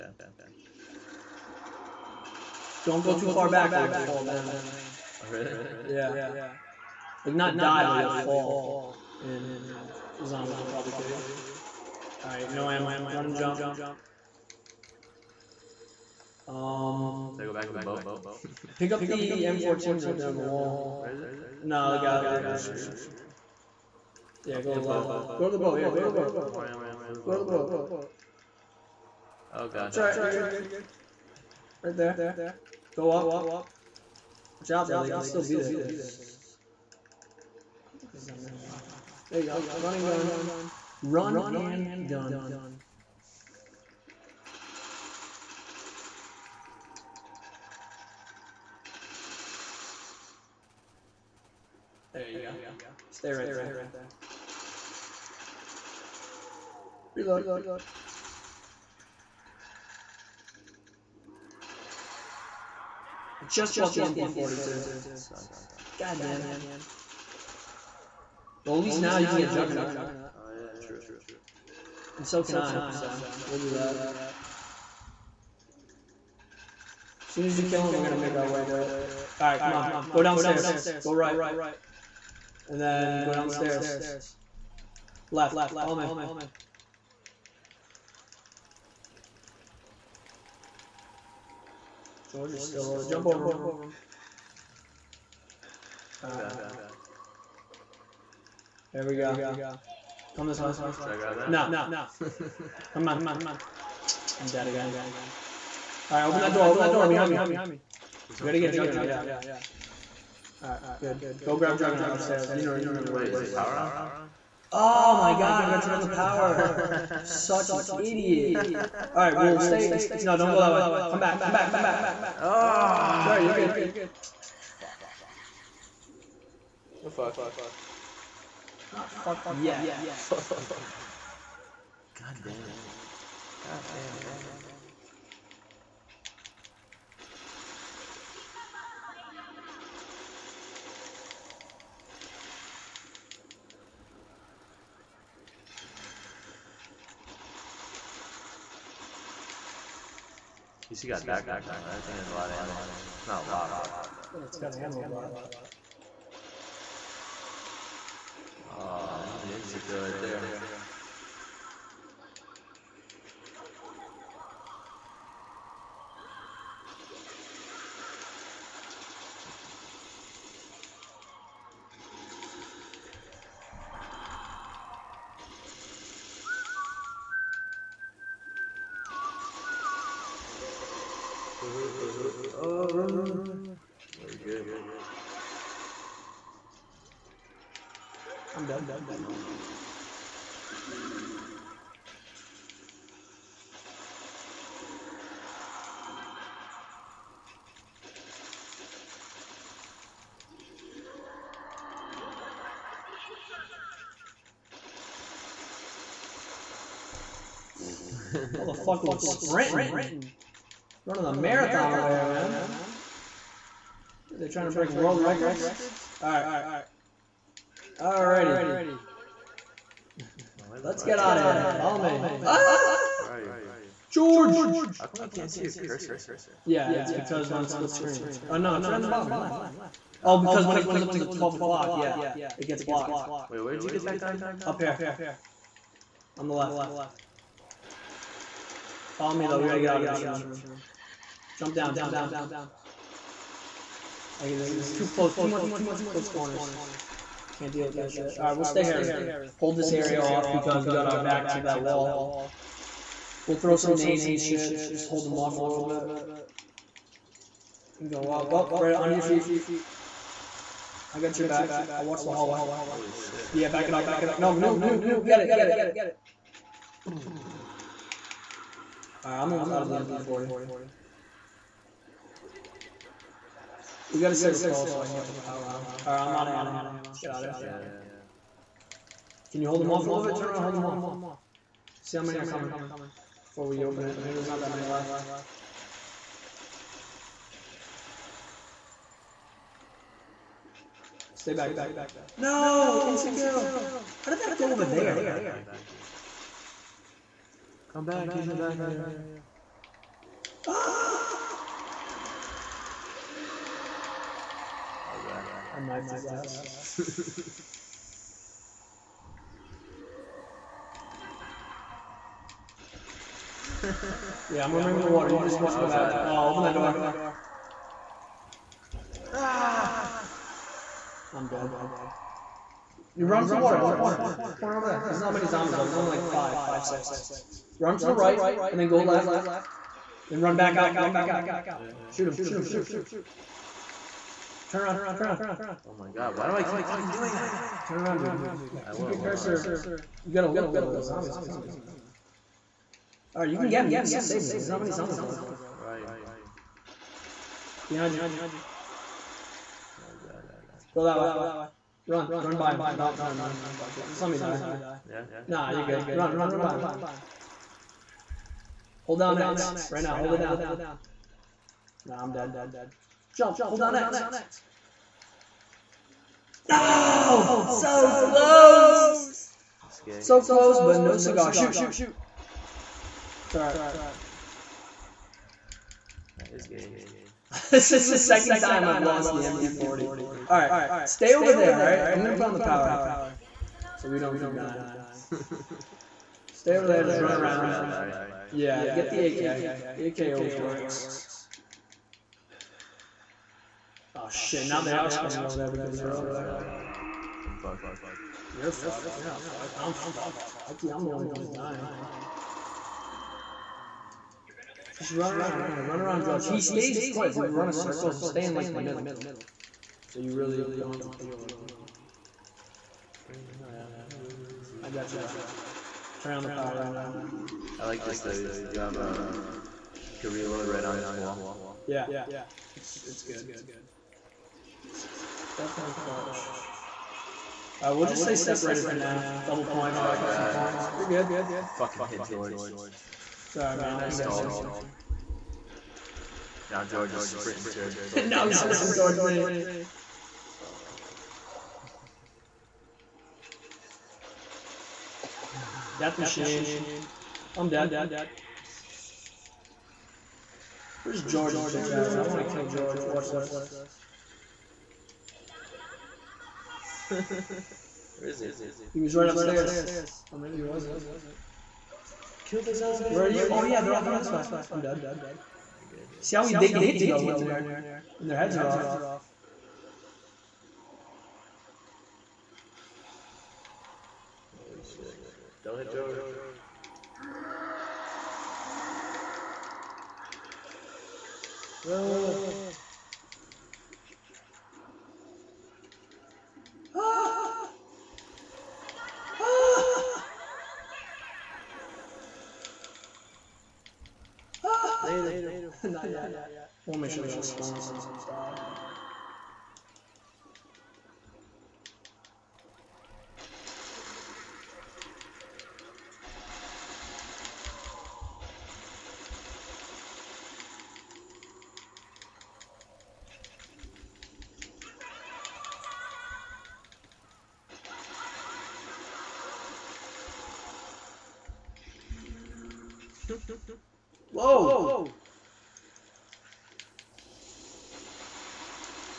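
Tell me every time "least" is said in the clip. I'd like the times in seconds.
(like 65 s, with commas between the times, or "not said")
68 s, 150 s.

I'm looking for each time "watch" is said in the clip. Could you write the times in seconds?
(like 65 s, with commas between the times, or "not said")
34 s, 262 s, 315 s, 453 s.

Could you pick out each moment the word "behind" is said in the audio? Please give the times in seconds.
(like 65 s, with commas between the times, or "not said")
107 s, 347 s.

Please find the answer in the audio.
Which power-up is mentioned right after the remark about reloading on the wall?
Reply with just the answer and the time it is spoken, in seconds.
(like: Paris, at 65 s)
Double points, at 429 s.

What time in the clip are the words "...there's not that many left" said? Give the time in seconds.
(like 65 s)
284 s.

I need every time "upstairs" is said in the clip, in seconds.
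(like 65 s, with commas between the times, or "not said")
112 s, 459 s.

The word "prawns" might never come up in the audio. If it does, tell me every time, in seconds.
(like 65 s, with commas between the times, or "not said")
not said.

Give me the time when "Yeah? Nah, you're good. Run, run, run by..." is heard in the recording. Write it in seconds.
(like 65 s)
355 s.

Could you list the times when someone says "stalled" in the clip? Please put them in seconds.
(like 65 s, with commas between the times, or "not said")
434 s.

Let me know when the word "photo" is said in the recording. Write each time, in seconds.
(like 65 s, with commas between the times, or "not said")
not said.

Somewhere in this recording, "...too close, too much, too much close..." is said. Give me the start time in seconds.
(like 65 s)
244 s.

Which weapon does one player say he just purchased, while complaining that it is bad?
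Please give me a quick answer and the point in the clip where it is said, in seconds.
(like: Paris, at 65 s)
MP42, at 64 s.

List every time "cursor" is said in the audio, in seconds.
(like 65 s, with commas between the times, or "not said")
225 s, 339 s.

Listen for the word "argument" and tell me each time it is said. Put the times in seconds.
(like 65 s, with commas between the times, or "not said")
not said.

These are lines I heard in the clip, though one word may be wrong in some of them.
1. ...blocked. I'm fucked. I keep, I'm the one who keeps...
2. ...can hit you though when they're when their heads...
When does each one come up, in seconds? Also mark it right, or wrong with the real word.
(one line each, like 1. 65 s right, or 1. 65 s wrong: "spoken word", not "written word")
1. 399 s wrong: "fucked", not "blocked"
2. 466 s right.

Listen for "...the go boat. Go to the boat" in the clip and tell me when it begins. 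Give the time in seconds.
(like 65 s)
27 s.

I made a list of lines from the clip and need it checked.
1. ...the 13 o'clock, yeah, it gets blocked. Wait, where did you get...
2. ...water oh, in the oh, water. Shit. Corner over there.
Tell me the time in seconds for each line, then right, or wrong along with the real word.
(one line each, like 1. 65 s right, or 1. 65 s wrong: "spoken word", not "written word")
1. 231 s wrong: "12", not "13"
2. 323 s wrong: "corner", not "water".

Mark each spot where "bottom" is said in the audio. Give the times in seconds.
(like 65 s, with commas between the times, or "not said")
229 s.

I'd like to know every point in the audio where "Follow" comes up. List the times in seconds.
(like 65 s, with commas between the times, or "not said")
85 s, 221 s, 239 s.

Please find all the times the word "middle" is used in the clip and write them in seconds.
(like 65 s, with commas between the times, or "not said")
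408 s.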